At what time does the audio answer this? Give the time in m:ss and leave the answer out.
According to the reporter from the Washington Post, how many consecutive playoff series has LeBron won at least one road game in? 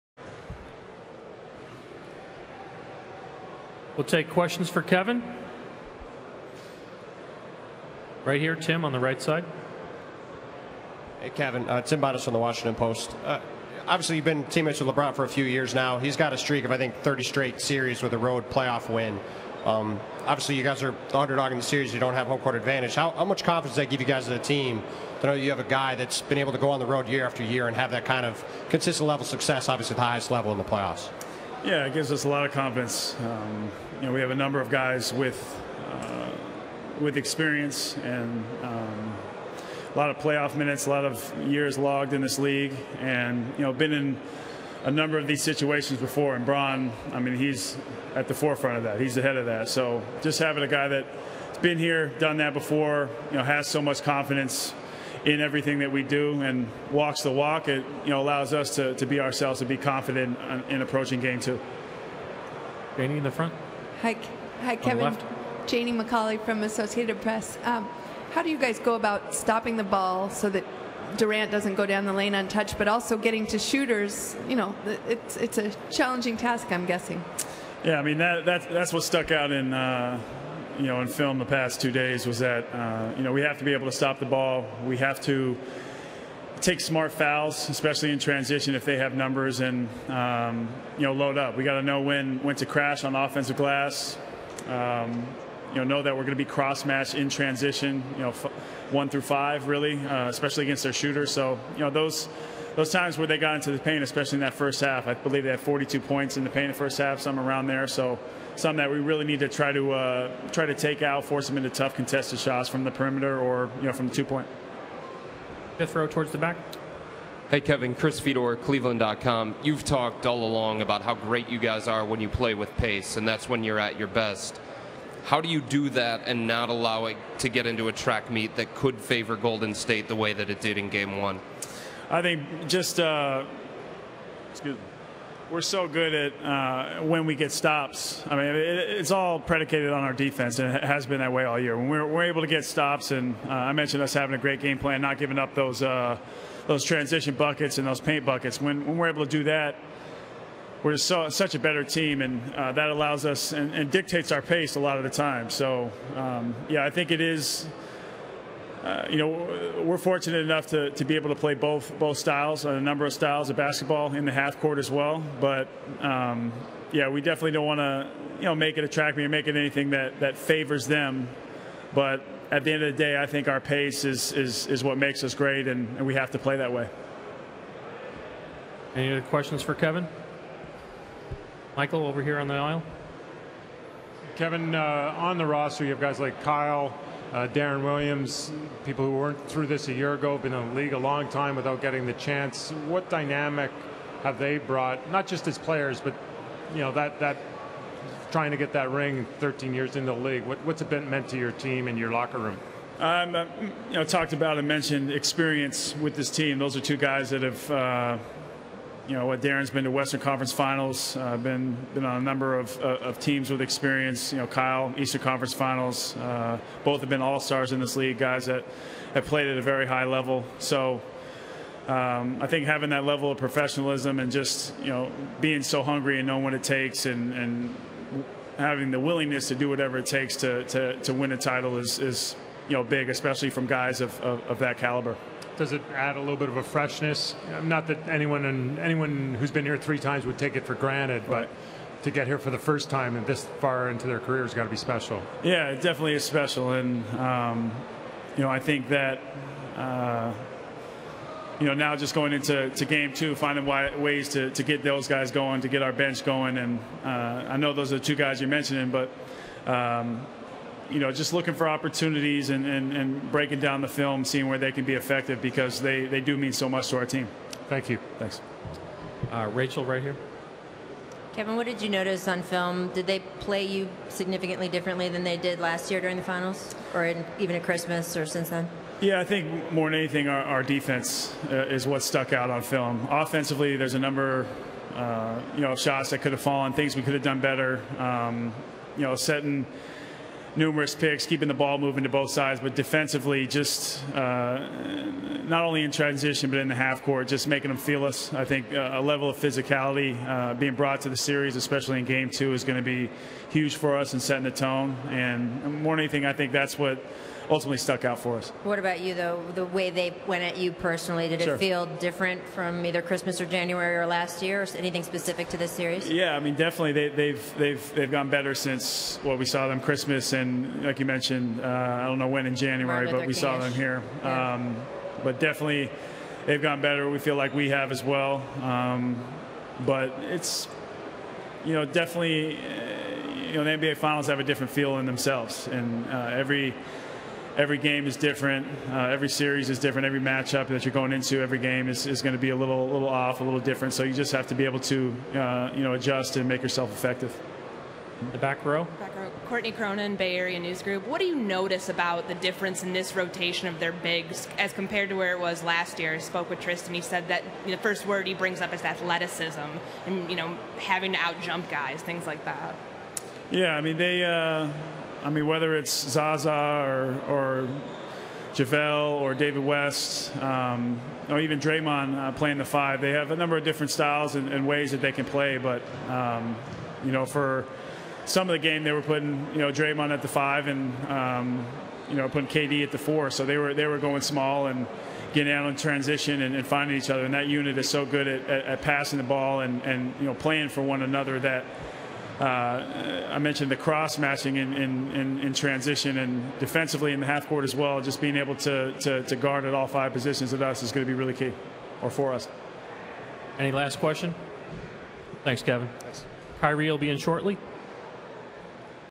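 0:16.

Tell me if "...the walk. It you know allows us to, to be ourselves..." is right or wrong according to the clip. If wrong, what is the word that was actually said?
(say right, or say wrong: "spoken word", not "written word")
right.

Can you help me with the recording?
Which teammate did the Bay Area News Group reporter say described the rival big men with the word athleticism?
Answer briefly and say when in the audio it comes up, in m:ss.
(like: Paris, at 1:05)
Tristan, at 5:56.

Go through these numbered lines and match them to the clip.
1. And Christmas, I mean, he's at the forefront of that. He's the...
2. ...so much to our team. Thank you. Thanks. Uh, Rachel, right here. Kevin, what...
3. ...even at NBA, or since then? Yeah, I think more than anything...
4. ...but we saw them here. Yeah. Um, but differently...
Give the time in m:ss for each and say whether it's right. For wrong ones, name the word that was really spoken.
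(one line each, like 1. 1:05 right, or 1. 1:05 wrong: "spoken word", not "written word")
1. 0:46 wrong: "Bron", not "Christmas"
2. 4:26 right
3. 4:37 wrong: "Christmas", not "NBA"
4. 5:23 wrong: "definitely", not "differently".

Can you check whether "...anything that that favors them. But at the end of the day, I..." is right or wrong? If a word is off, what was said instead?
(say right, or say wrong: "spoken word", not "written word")
right.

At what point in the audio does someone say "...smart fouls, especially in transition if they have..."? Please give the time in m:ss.
1:26.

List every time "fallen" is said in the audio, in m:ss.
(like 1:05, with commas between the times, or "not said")
4:46.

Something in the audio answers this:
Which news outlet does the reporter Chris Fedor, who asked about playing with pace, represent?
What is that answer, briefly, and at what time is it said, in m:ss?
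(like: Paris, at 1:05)
Cleveland.com, at 1:58.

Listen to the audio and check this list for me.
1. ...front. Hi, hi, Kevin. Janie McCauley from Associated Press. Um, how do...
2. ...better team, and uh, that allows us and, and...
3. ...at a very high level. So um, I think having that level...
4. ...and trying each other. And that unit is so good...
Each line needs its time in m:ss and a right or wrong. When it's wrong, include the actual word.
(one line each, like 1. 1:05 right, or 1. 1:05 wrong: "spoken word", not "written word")
1. 1:03 right
2. 2:31 right
3. 3:39 right
4. 6:26 wrong: "finding", not "trying".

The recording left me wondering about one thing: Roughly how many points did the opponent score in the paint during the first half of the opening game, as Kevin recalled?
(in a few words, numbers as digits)
42.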